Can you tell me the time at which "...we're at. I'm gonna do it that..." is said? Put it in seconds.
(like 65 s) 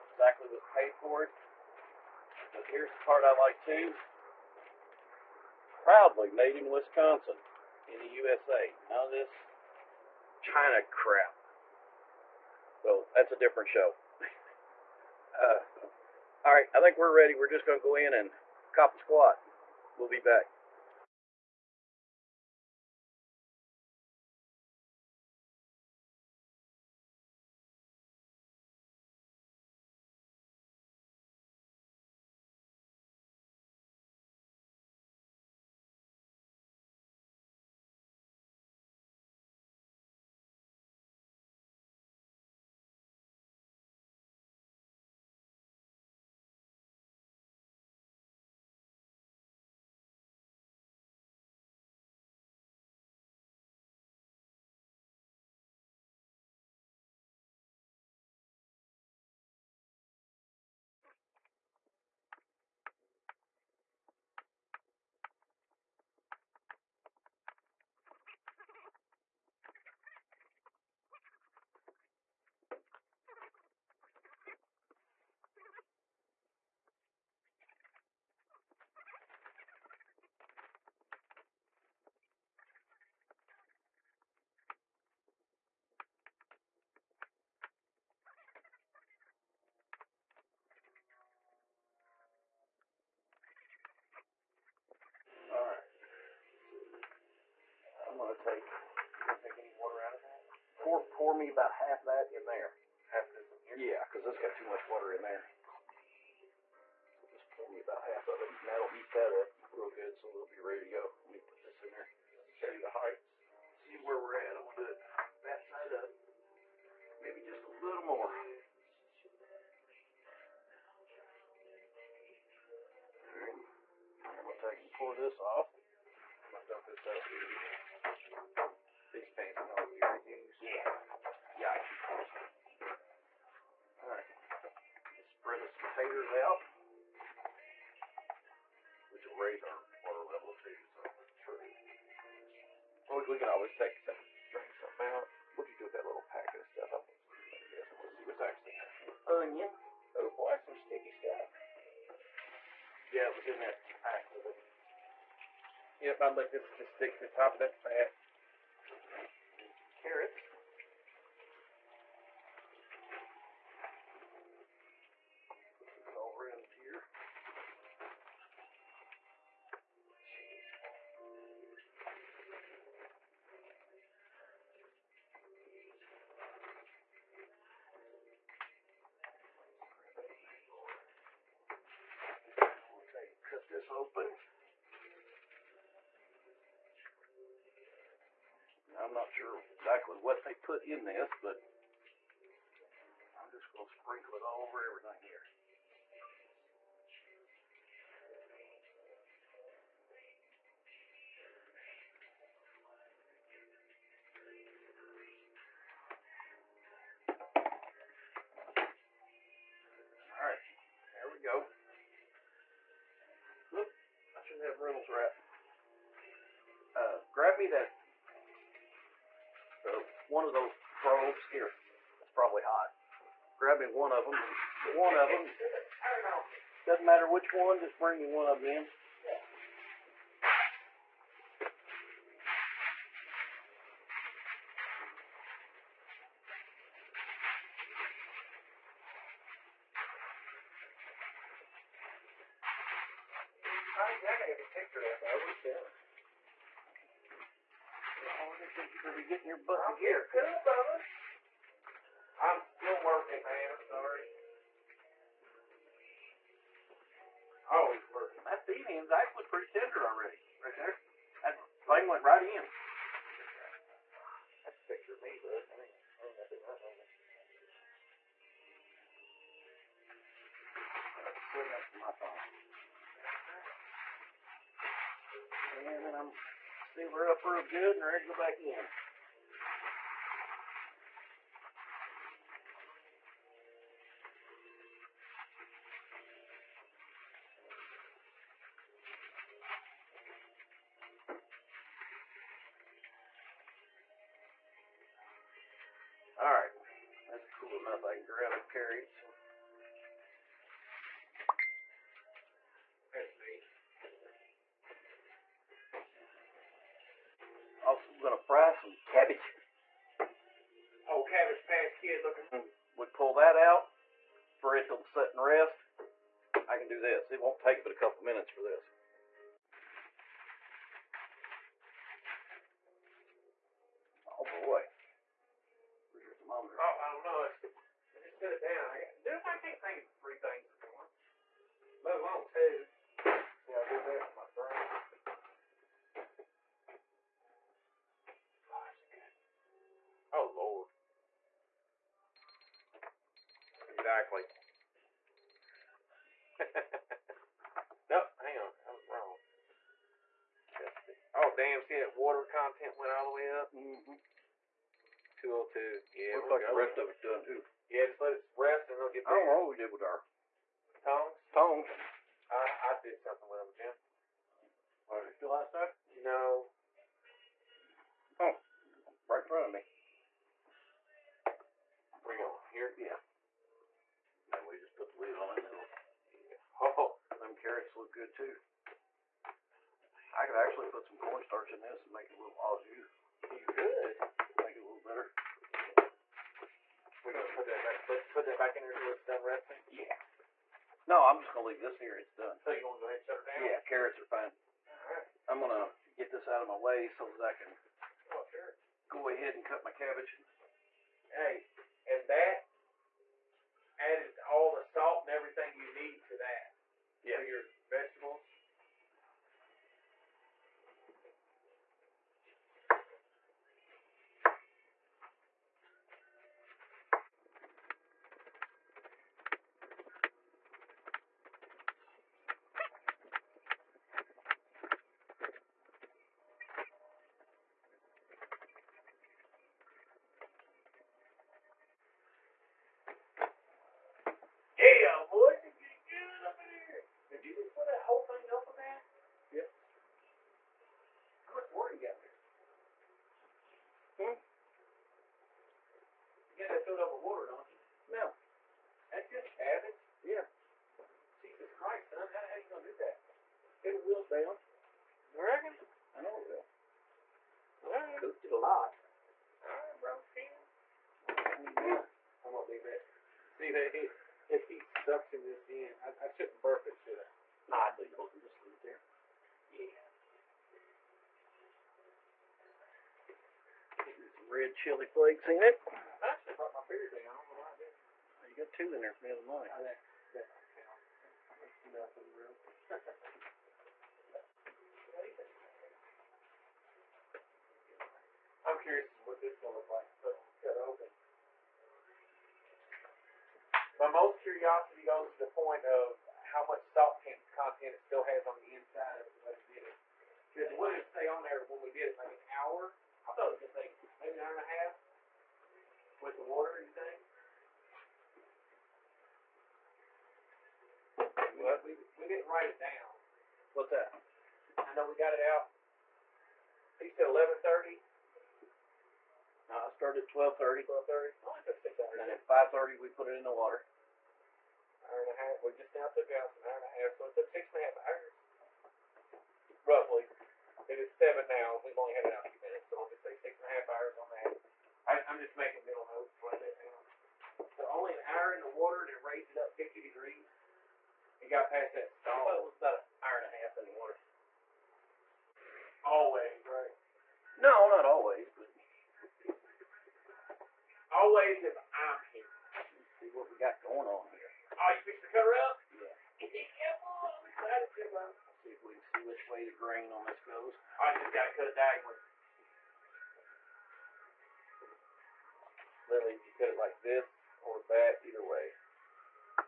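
114 s.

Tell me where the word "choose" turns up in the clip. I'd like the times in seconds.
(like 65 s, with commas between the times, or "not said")
not said.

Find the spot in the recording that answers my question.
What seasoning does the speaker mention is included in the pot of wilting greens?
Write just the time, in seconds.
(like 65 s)
474 s.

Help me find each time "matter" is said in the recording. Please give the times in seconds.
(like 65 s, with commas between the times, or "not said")
227 s.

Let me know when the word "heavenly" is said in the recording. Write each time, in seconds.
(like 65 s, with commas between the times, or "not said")
not said.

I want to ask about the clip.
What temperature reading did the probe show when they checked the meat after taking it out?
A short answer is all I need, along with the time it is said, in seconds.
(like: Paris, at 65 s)
202, at 355 s.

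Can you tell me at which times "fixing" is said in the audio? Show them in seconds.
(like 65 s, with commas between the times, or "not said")
555 s.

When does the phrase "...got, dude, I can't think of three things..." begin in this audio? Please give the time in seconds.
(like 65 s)
329 s.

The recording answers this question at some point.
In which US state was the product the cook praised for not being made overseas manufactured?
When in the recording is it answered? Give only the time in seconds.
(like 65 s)
6 s.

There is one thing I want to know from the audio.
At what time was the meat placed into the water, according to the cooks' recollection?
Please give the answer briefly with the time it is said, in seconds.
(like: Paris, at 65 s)
5:30, at 522 s.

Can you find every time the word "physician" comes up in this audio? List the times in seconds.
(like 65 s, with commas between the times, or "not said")
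not said.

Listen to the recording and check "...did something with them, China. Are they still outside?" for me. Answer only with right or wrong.
wrong.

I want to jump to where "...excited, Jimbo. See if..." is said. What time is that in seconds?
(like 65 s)
557 s.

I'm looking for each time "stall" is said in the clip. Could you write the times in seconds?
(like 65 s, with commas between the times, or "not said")
542 s.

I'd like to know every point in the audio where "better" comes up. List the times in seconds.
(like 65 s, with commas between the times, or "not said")
359 s, 385 s.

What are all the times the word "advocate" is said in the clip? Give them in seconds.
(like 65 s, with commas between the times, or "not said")
not said.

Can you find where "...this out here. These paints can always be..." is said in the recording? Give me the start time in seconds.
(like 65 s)
126 s.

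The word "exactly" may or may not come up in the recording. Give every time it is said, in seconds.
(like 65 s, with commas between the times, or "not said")
0 s, 343 s.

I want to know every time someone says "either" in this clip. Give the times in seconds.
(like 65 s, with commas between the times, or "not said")
568 s.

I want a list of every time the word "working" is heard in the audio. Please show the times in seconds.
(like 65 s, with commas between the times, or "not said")
253 s, 258 s.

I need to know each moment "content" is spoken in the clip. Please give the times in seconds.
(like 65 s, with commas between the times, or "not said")
352 s, 497 s.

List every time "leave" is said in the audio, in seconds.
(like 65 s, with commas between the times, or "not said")
391 s, 462 s, 468 s.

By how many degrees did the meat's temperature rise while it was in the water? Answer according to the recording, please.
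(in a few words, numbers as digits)
50.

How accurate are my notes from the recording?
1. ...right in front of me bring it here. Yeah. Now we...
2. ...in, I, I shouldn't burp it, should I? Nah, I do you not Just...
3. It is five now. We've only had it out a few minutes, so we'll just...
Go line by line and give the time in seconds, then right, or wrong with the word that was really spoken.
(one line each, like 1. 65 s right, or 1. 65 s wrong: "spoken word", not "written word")
1. 369 s right
2. 465 s right
3. 530 s wrong: "seven", not "five".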